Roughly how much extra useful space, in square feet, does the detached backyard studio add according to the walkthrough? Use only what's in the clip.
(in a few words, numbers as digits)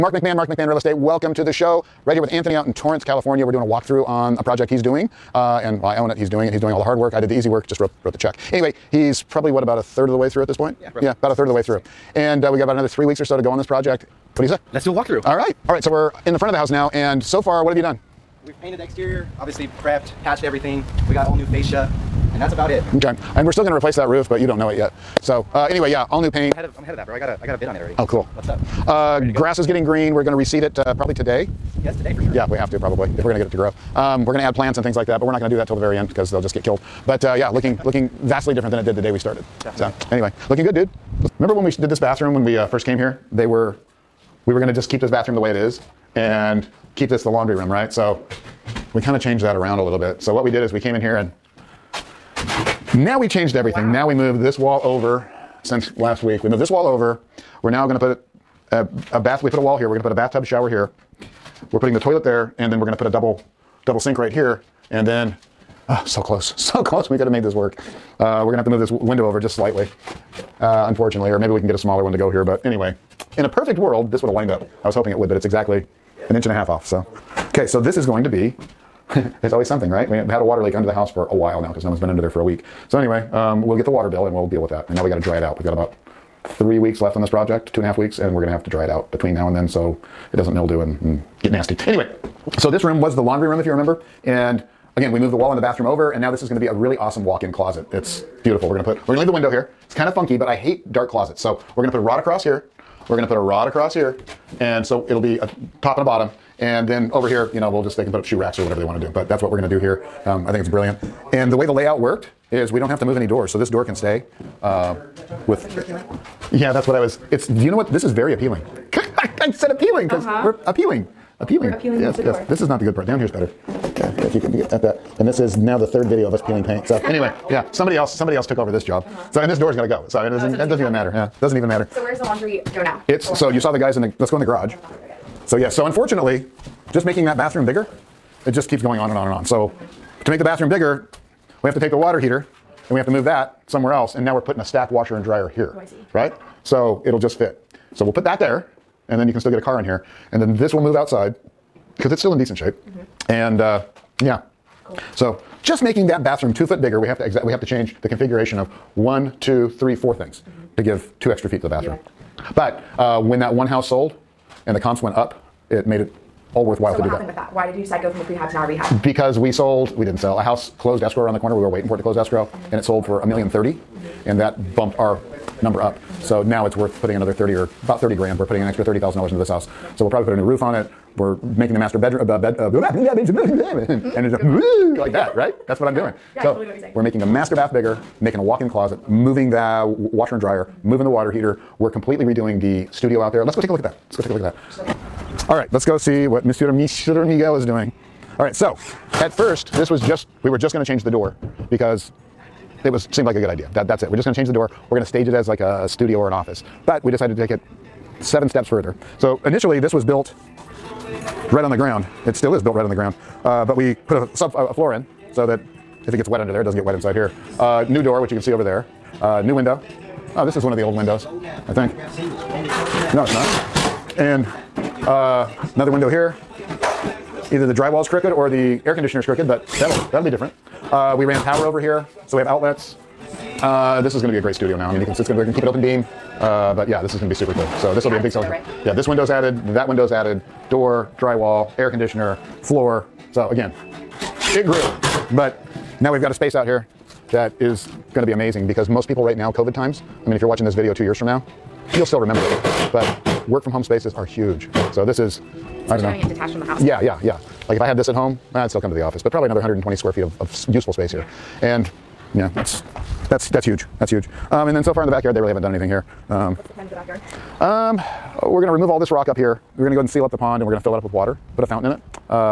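120 square feet.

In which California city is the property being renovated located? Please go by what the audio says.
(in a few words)
Torrance.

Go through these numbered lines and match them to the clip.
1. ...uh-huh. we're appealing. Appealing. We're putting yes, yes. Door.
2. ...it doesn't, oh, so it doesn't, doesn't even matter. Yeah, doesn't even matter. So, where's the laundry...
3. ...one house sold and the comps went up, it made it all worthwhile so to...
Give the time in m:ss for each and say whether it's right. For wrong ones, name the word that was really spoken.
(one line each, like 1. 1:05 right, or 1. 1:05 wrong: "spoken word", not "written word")
1. 2:00 wrong: "appealing", not "putting"
2. 2:10 right
3. 2:43 right.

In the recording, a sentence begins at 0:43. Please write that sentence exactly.
They were we were going to just keep this bathroom the way it is and keep this the laundry room, right?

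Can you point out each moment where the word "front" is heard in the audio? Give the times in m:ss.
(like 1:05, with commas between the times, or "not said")
0:16.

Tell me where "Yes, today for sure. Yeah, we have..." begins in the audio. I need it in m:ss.
0:31.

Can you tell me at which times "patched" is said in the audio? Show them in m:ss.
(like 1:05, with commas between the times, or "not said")
0:20.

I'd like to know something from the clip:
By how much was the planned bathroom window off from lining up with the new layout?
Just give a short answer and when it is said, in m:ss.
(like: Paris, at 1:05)
An inch and a half, at 1:16.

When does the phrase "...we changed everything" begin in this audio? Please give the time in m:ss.
0:53.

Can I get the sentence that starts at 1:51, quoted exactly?
And the way the layout worked is we don't have to move any doors.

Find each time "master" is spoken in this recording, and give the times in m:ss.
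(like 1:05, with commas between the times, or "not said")
3:01, 3:07.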